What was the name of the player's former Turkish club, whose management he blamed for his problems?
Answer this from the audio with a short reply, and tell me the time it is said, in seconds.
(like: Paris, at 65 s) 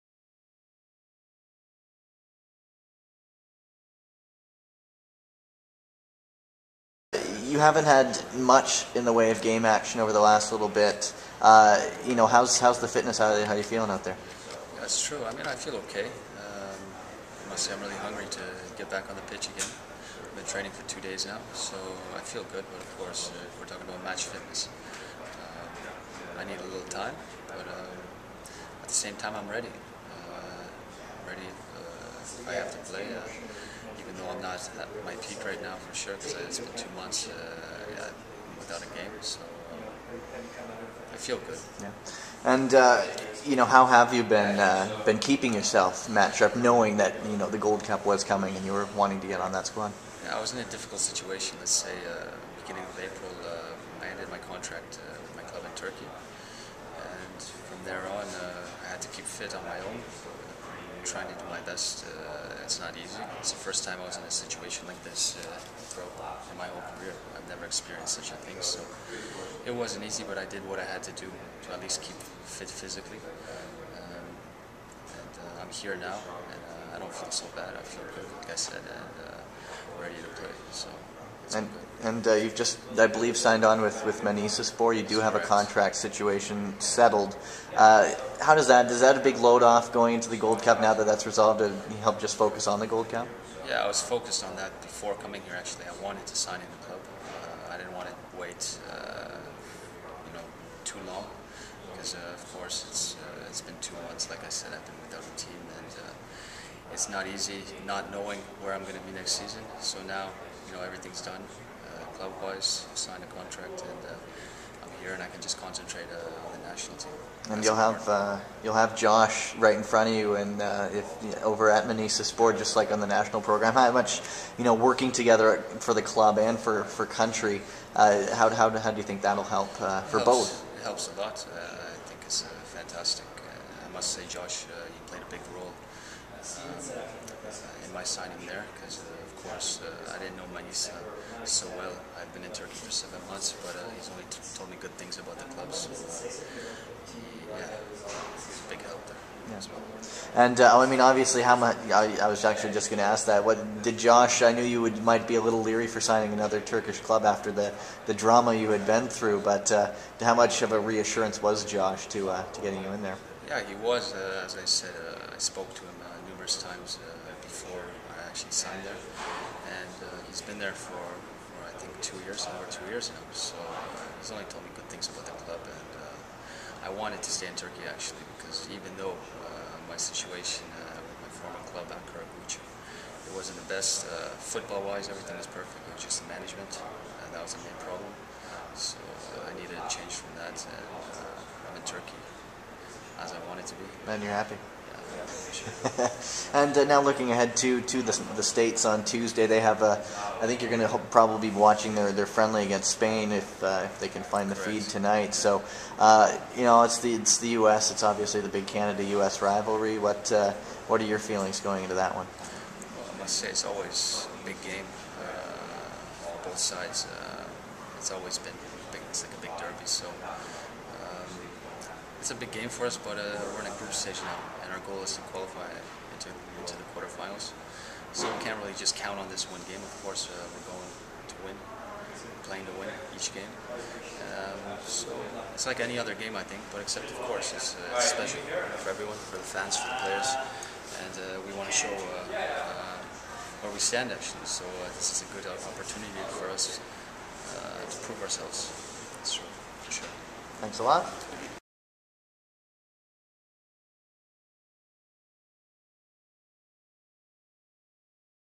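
Ankaragucu, at 181 s.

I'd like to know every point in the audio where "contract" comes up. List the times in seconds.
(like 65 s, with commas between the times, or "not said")
54 s, 85 s, 113 s.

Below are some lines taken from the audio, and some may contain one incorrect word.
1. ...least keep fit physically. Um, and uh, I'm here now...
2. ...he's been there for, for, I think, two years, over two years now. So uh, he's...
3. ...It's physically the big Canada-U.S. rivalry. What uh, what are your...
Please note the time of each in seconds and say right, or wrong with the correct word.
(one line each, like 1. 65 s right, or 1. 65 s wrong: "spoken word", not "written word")
1. 71 s right
2. 170 s right
3. 207 s wrong: "obviously", not "physically".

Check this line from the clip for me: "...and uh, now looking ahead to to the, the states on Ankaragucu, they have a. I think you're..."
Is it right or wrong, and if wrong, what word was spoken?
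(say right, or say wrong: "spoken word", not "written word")
wrong: "Tuesday", not "Ankaragucu".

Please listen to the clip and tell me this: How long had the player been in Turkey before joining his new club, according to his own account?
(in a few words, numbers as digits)
7 months.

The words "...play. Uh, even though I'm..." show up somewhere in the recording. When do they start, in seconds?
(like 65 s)
32 s.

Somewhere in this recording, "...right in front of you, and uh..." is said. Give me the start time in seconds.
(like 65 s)
119 s.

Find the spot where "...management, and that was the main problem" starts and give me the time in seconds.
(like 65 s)
186 s.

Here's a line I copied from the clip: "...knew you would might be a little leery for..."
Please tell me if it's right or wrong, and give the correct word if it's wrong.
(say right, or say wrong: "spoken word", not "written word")
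right.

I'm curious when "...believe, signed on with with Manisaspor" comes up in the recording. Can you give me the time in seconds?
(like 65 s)
83 s.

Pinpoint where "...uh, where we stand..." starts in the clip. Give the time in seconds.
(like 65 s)
242 s.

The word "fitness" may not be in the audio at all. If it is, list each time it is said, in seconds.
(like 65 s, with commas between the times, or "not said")
12 s, 24 s.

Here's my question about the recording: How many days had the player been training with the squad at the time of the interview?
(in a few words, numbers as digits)
2.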